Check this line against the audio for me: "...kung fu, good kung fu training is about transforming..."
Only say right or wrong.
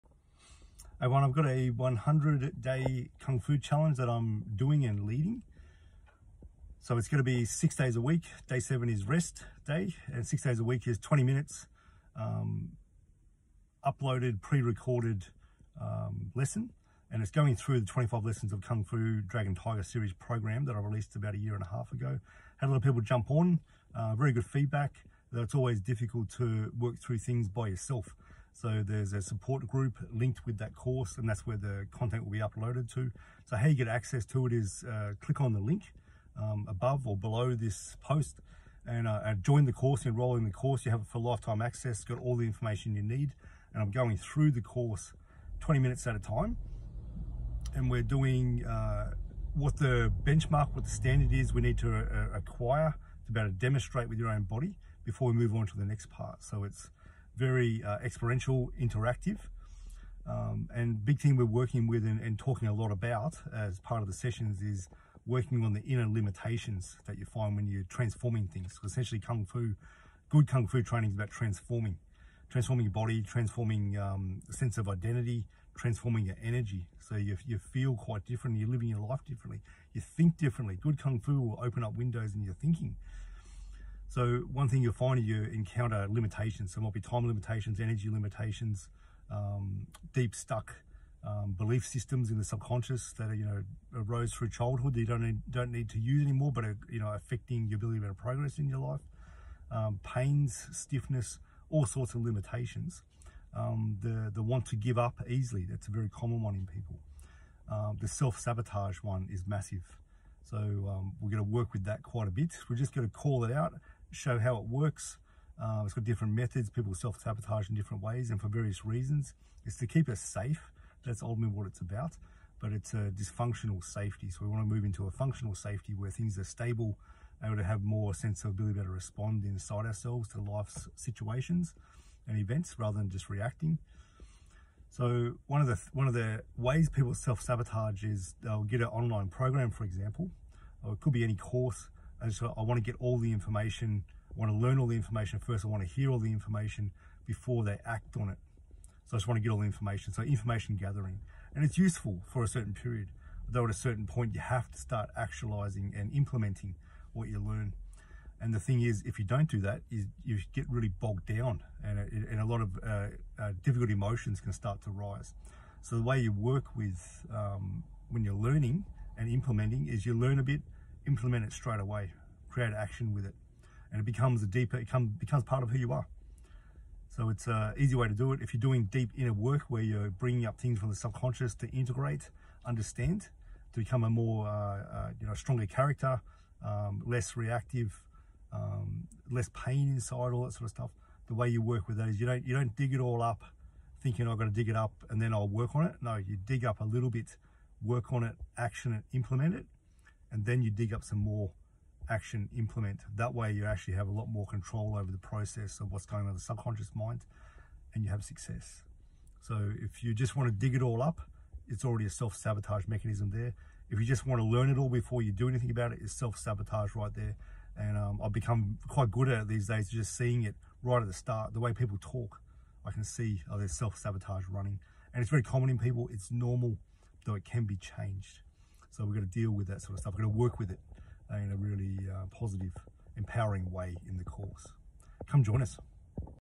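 right.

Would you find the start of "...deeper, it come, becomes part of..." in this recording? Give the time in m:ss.
2:54.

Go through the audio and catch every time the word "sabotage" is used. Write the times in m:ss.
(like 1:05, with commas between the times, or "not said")
1:48, 1:56, 2:17, 3:32, 3:36, 3:43.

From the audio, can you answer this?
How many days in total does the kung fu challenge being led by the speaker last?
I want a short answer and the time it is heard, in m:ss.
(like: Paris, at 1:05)
100 days, at 0:01.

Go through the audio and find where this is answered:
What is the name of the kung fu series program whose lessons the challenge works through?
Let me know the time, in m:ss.
0:19.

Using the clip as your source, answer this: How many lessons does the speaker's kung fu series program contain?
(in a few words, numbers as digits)
25.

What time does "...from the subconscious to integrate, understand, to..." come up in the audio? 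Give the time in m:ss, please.
3:00.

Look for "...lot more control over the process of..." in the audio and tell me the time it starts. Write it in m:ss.
3:24.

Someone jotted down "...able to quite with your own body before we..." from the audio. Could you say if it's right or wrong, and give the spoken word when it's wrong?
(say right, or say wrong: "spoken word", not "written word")
wrong: "demonstrate", not "quite".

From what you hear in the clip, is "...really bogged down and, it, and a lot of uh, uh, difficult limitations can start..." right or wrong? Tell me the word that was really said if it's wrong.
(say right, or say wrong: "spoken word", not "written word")
wrong: "emotions", not "limitations".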